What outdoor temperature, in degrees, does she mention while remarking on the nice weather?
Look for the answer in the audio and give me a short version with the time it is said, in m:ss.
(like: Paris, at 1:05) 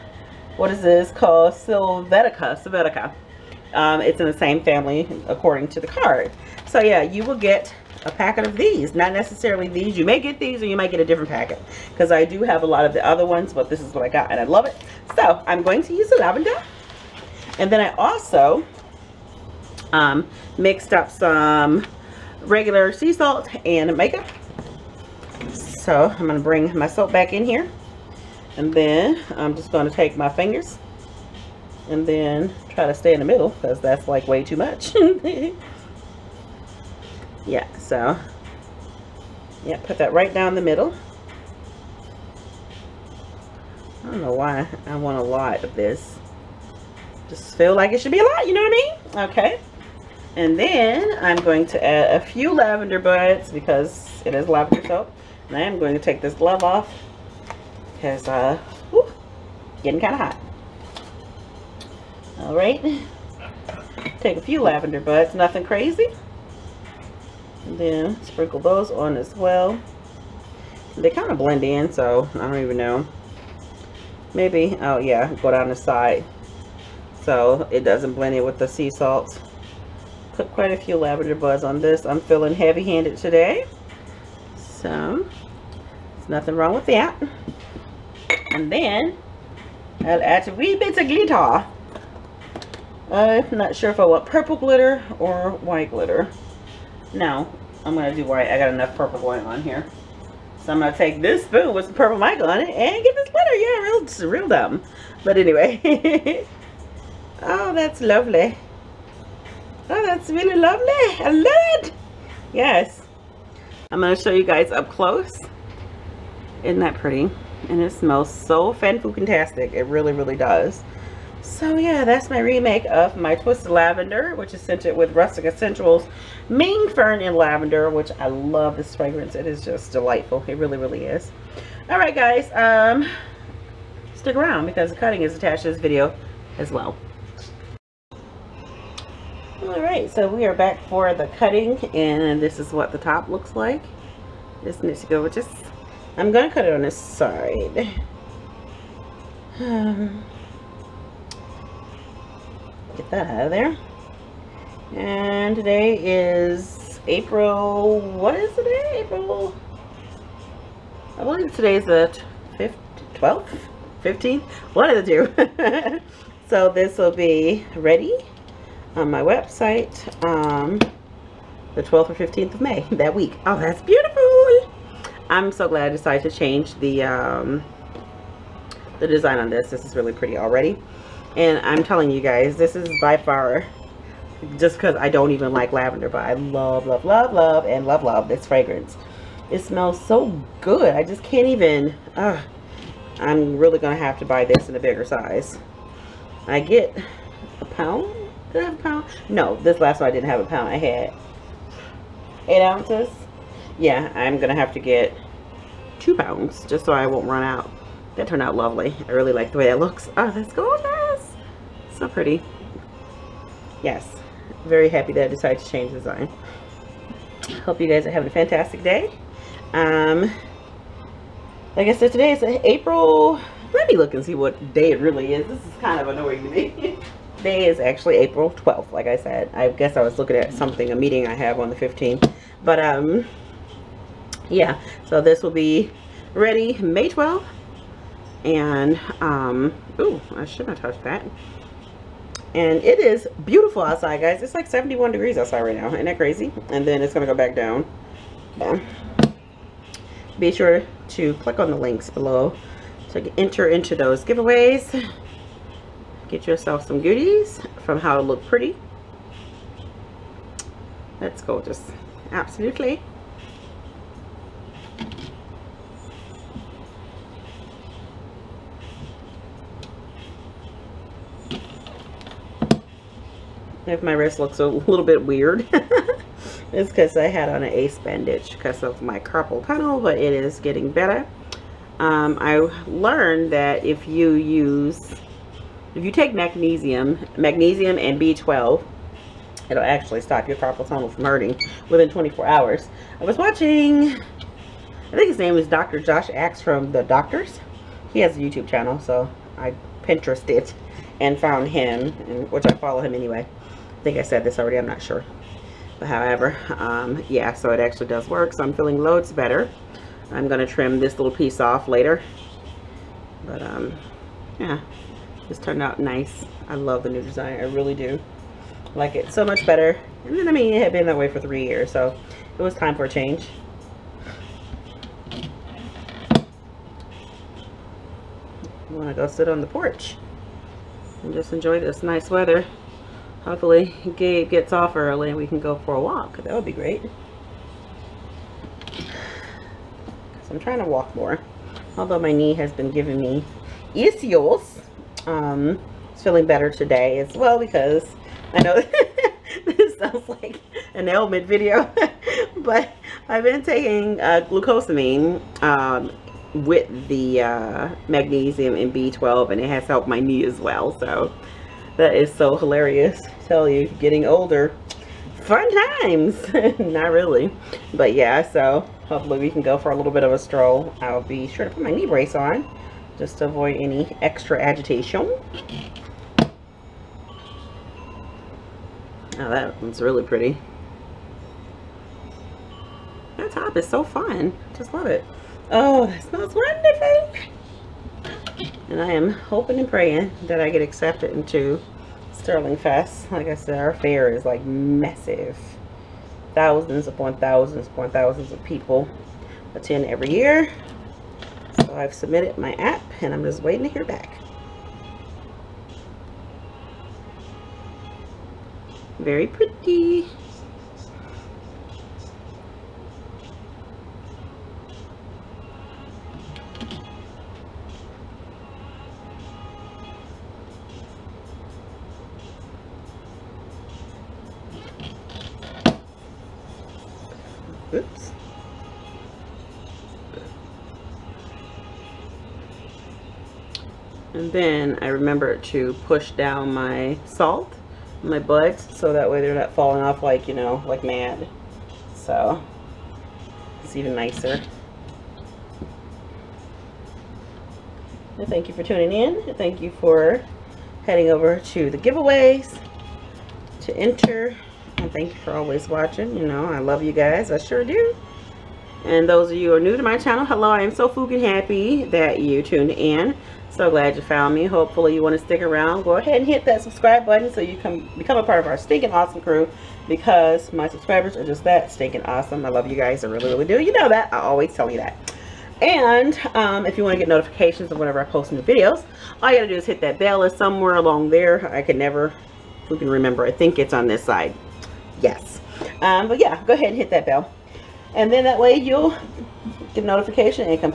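71 degrees, at 4:04.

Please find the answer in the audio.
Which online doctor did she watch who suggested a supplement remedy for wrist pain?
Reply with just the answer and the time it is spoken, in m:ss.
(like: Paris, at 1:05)
Dr. Josh Axe, at 4:55.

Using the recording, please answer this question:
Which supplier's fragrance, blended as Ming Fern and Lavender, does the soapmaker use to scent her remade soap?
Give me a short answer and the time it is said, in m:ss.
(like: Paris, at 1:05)
Rustic Escentuals, at 2:05.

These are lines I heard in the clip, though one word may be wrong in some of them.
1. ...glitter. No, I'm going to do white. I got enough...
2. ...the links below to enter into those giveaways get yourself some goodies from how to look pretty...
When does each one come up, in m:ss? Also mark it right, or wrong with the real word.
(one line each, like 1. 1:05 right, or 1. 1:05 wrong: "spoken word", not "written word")
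1. 1:35 right
2. 4:11 right.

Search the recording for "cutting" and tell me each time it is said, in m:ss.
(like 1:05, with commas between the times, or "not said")
2:14, 2:21.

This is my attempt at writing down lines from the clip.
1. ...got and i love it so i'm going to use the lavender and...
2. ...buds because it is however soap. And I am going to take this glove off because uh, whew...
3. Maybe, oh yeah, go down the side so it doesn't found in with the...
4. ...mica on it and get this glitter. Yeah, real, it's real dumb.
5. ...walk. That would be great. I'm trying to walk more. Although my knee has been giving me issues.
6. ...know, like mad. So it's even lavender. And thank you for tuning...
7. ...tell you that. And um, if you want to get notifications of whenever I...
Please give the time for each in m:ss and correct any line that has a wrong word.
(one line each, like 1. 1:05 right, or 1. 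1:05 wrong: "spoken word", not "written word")
1. 0:14 right
2. 0:52 wrong: "lavender", not "however"
3. 1:14 wrong: "blend", not "found"
4. 1:42 right
5. 5:36 right
6. 7:20 wrong: "nicer", not "lavender"
7. 7:54 right.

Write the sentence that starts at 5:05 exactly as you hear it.
But however, um, yeah, so it actually does work.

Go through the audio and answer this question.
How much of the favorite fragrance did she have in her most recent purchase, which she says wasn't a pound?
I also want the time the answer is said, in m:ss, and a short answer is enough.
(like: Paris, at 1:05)
8 ounces, at 3:22.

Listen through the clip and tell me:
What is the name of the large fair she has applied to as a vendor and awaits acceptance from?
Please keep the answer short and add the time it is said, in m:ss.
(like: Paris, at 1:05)
Sterling Fest, at 6:32.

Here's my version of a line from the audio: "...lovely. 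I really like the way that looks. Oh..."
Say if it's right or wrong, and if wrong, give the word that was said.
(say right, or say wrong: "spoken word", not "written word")
right.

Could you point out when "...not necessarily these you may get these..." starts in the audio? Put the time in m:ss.
0:08.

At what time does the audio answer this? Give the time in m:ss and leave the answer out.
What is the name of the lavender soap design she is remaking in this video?
2:03.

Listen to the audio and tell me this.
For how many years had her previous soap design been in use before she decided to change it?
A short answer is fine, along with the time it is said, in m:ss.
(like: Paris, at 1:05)
3, at 5:21.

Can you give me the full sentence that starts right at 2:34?
And today is April, what is today?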